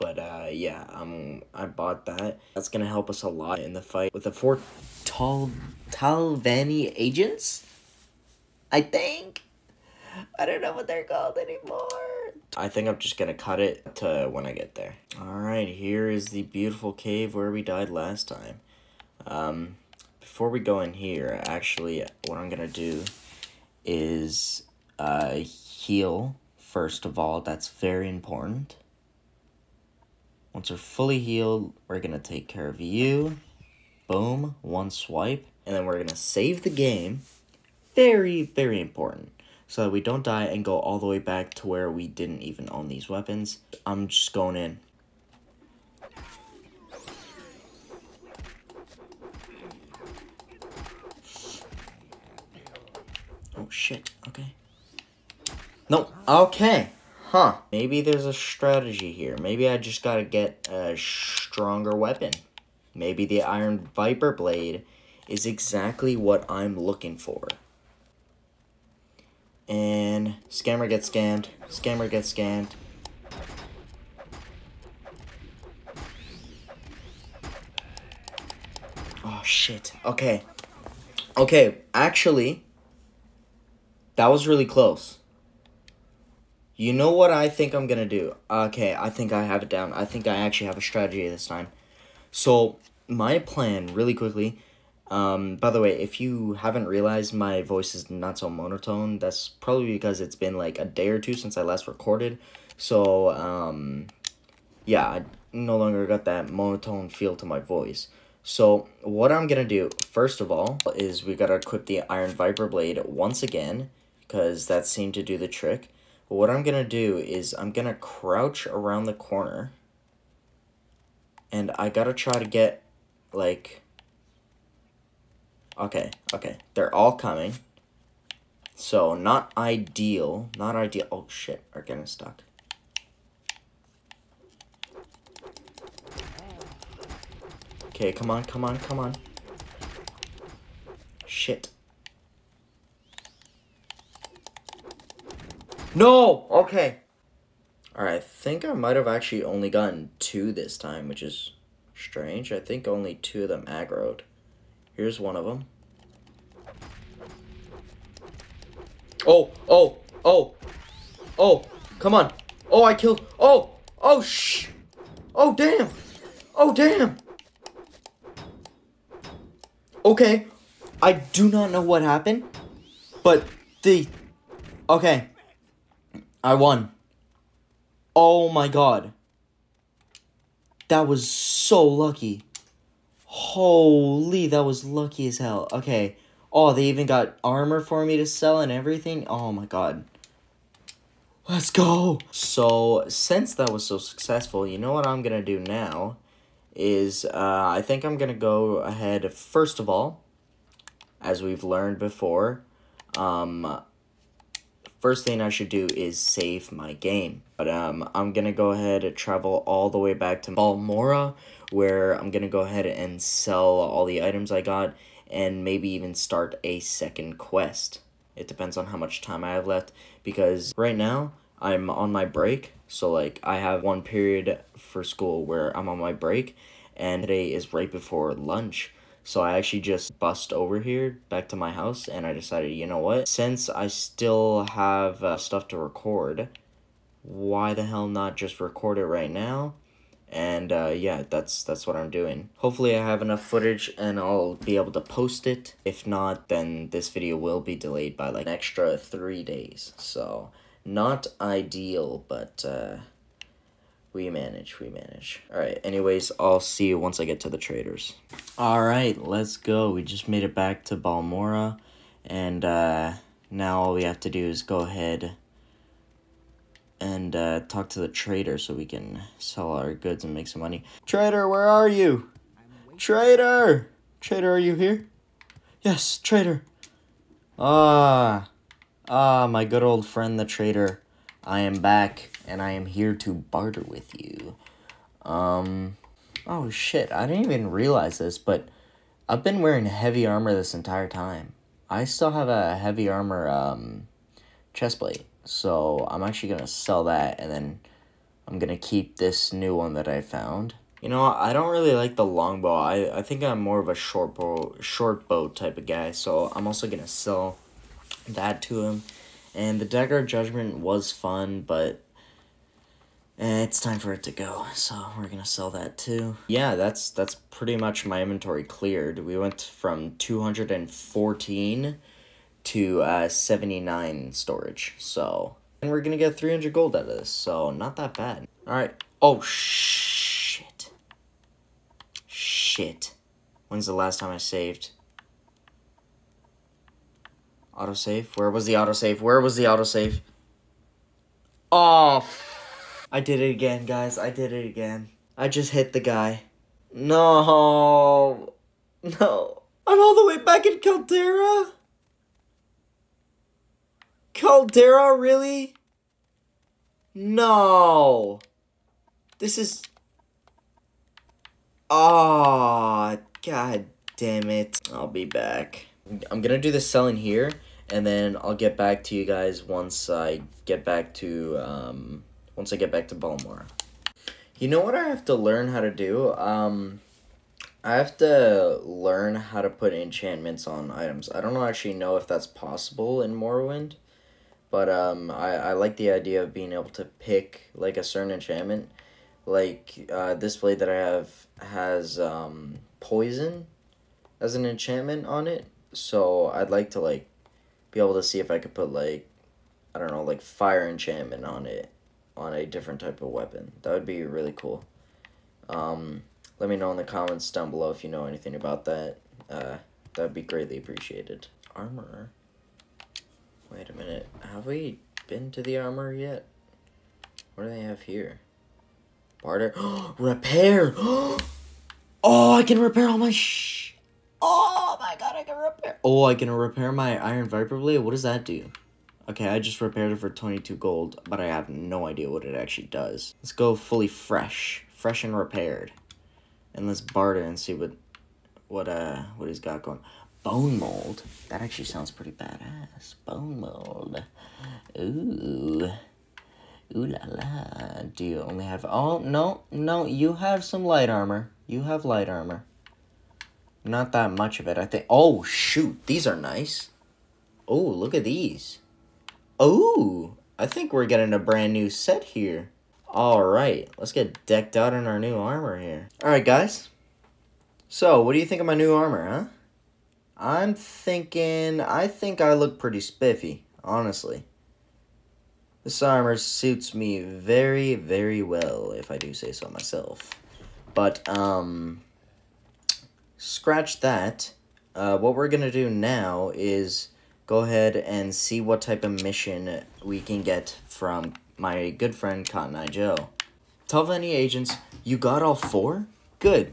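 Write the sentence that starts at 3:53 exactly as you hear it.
Since I still have uh, stuff to record, why the hell not just record it right now?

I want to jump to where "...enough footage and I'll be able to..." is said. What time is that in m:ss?
4:03.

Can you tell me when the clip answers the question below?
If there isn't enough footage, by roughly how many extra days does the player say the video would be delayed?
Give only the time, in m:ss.
4:08.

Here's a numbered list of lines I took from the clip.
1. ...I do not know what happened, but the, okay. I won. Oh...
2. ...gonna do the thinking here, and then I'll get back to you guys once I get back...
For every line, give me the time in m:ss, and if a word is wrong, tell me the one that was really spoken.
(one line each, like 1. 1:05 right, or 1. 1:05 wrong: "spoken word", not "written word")
1. 2:51 right
2. 6:06 wrong: "selling", not "thinking".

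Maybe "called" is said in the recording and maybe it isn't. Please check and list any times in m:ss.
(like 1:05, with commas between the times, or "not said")
0:11.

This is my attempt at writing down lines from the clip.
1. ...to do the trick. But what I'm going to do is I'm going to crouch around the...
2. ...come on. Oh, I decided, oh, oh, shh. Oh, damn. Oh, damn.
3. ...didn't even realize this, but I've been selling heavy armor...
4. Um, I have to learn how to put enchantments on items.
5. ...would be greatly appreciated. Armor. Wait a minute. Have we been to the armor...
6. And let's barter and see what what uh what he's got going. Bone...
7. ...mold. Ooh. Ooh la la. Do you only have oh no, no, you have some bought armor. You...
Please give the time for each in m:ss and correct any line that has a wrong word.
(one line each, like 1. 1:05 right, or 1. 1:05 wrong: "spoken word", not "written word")
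1. 1:55 right
2. 2:41 wrong: "killed", not "decided"
3. 4:47 wrong: "wearing", not "selling"
4. 6:16 right
5. 6:50 right
6. 7:16 right
7. 7:23 wrong: "light", not "bought".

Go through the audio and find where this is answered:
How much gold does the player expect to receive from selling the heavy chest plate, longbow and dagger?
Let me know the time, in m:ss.
5:26.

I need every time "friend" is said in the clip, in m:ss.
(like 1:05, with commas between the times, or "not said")
4:40, 8:12.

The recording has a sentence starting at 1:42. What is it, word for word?
So, um, yeah, I no longer got that monotone feel to my voice.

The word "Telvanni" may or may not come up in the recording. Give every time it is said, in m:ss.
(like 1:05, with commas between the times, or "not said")
0:05, 8:13.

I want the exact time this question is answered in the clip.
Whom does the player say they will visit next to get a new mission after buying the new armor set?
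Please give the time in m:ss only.
8:12.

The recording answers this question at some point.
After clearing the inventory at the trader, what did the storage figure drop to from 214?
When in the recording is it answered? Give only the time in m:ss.
5:23.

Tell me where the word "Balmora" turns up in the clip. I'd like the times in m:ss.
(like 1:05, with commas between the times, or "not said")
3:30, 4:20.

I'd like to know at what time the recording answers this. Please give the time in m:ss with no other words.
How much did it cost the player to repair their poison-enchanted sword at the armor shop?
7:10.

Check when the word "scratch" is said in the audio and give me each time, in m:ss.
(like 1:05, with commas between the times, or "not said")
8:03.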